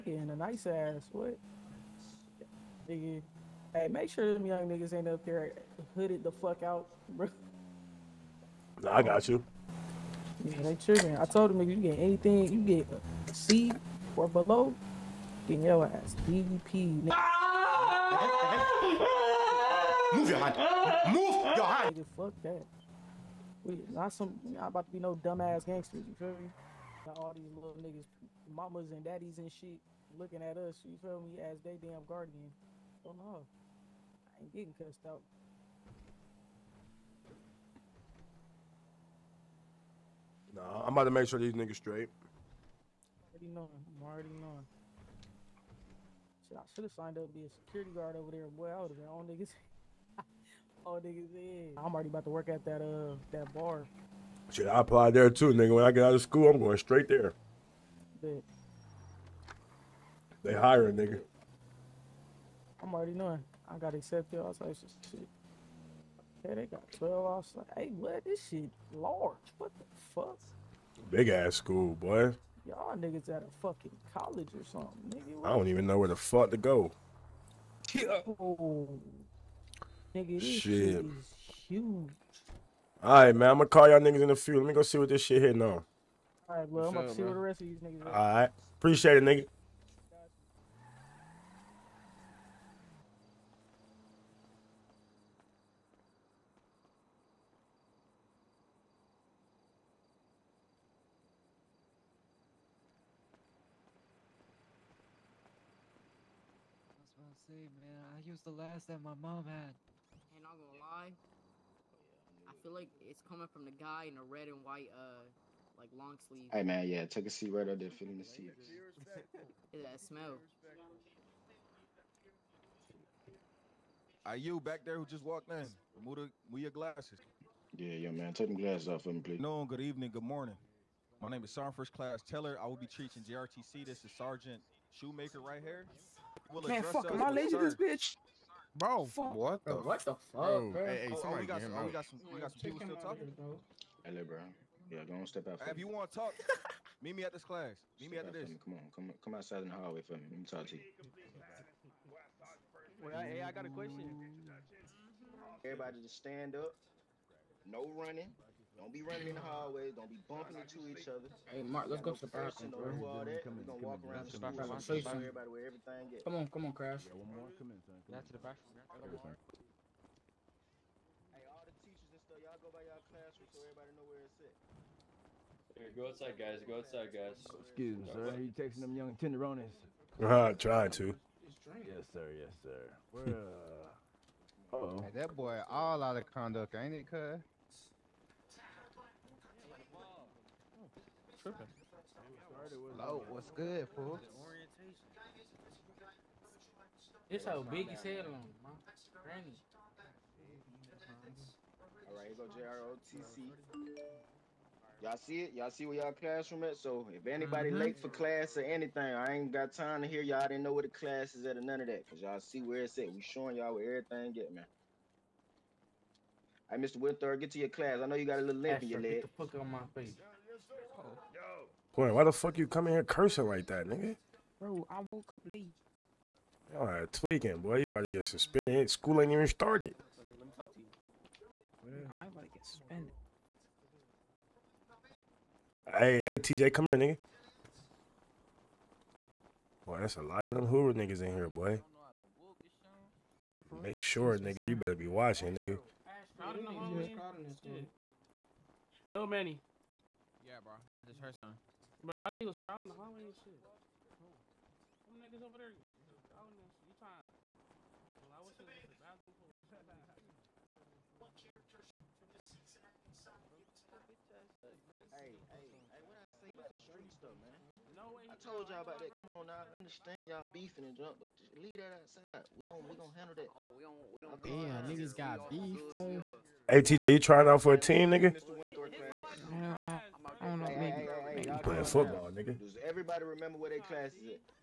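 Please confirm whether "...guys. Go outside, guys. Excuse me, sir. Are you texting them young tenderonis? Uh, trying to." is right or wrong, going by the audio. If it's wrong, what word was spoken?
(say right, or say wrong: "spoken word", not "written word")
right.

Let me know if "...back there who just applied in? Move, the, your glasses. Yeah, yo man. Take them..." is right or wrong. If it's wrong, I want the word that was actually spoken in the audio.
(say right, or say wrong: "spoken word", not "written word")
wrong: "walked", not "applied".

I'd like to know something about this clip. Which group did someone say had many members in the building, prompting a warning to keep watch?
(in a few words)
Hoover.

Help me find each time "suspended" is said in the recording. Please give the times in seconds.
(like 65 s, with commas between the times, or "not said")
228 s, 232 s.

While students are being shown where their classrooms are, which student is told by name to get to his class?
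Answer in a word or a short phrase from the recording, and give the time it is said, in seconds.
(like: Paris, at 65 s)
Mr. Winter, at 216 s.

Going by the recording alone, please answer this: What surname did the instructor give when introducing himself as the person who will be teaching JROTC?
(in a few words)
Teller.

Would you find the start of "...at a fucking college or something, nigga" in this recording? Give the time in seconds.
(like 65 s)
73 s.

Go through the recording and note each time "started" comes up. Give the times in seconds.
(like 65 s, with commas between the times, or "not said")
229 s.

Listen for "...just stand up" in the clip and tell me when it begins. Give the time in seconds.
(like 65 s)
156 s.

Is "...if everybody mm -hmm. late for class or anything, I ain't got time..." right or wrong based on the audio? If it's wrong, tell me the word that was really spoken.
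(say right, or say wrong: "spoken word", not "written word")
wrong: "anybody", not "everybody".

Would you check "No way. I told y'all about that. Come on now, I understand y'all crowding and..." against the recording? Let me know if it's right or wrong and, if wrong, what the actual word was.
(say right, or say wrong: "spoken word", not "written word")
wrong: "beefing", not "crowding".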